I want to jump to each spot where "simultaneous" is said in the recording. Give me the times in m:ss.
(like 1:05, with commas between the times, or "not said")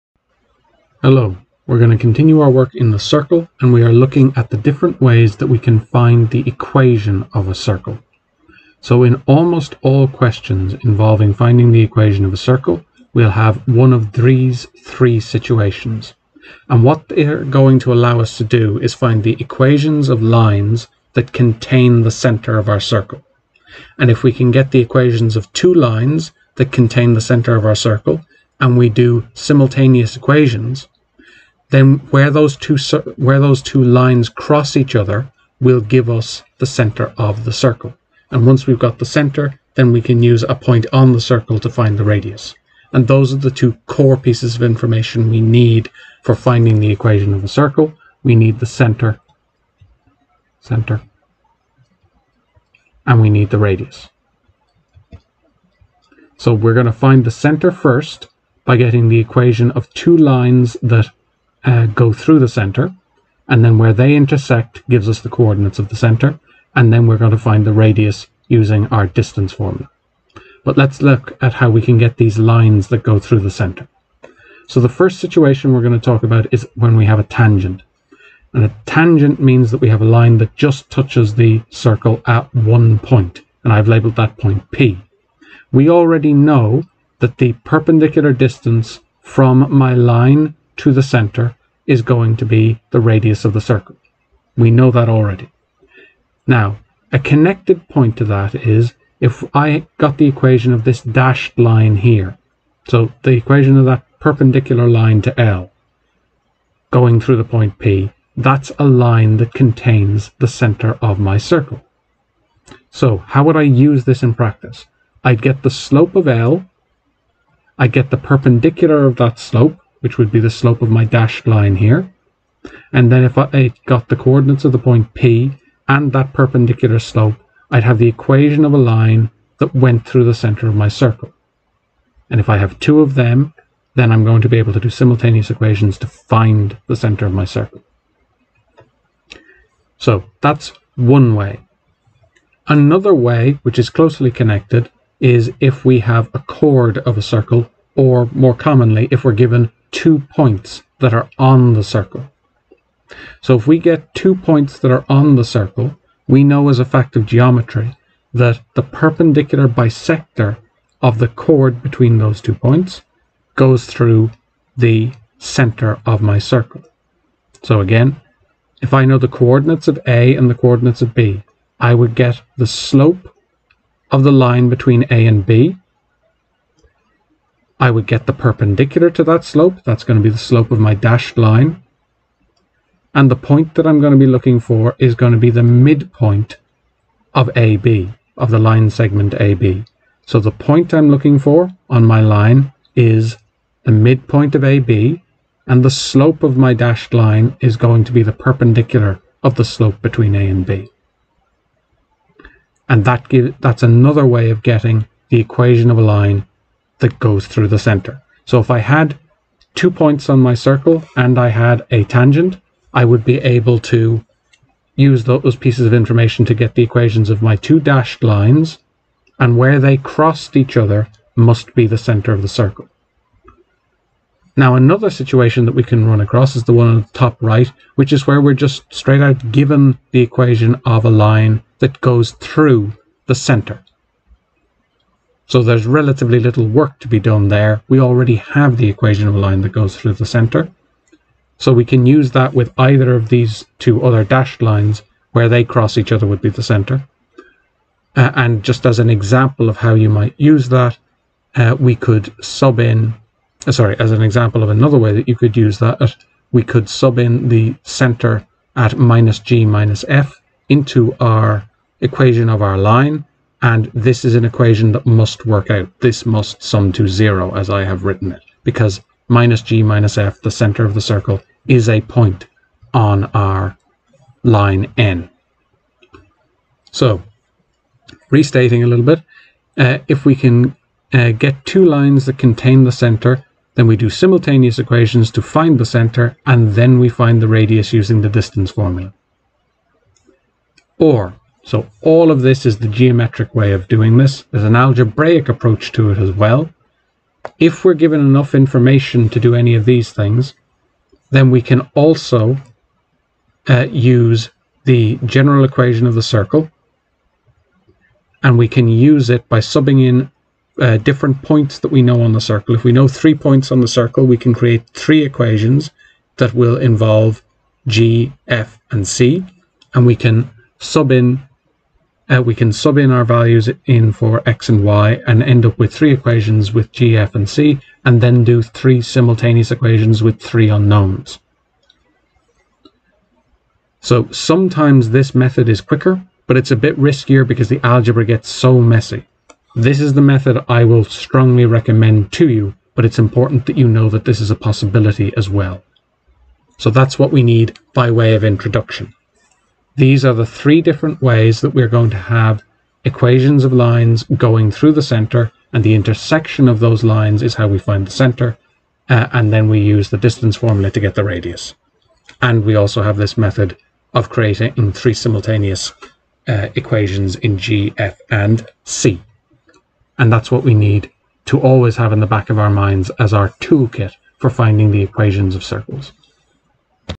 0:29, 2:14, 4:44, 5:29, 6:05.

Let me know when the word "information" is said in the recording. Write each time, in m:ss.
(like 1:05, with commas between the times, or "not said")
0:44, 3:35, 4:58.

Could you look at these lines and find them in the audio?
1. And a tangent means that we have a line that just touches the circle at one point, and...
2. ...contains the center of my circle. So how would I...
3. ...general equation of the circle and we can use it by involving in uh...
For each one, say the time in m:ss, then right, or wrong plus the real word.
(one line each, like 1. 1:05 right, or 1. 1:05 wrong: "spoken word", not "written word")
1. 1:18 right
2. 1:49 right
3. 5:05 wrong: "subbing", not "involving".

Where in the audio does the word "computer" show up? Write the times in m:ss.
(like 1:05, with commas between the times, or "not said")
not said.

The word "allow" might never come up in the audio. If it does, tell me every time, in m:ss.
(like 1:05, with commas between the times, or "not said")
0:17.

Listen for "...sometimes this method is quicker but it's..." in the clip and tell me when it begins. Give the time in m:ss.
5:34.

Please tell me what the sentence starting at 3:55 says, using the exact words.
So there's relatively little work to be done there.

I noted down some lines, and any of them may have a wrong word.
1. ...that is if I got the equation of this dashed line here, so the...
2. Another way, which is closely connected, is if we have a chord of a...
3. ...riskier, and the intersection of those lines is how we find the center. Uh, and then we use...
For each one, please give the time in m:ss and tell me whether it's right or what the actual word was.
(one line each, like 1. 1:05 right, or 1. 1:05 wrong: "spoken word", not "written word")
1. 1:38 right
2. 2:22 right
3. 5:55 wrong: "center", not "riskier".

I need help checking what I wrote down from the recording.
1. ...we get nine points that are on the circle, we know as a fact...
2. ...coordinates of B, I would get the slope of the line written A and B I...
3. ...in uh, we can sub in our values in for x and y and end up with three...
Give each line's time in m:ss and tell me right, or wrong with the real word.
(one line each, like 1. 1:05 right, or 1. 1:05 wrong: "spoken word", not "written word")
1. 2:33 wrong: "two", not "nine"
2. 2:50 wrong: "between", not "written"
3. 5:21 right.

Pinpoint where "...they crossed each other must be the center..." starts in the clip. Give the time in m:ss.
3:39.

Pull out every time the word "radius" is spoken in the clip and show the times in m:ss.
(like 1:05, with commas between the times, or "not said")
0:42, 0:53, 1:07, 1:32, 4:47, 6:01.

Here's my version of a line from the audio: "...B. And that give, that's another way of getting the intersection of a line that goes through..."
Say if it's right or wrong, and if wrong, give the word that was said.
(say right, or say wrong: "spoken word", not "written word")
wrong: "equation", not "intersection".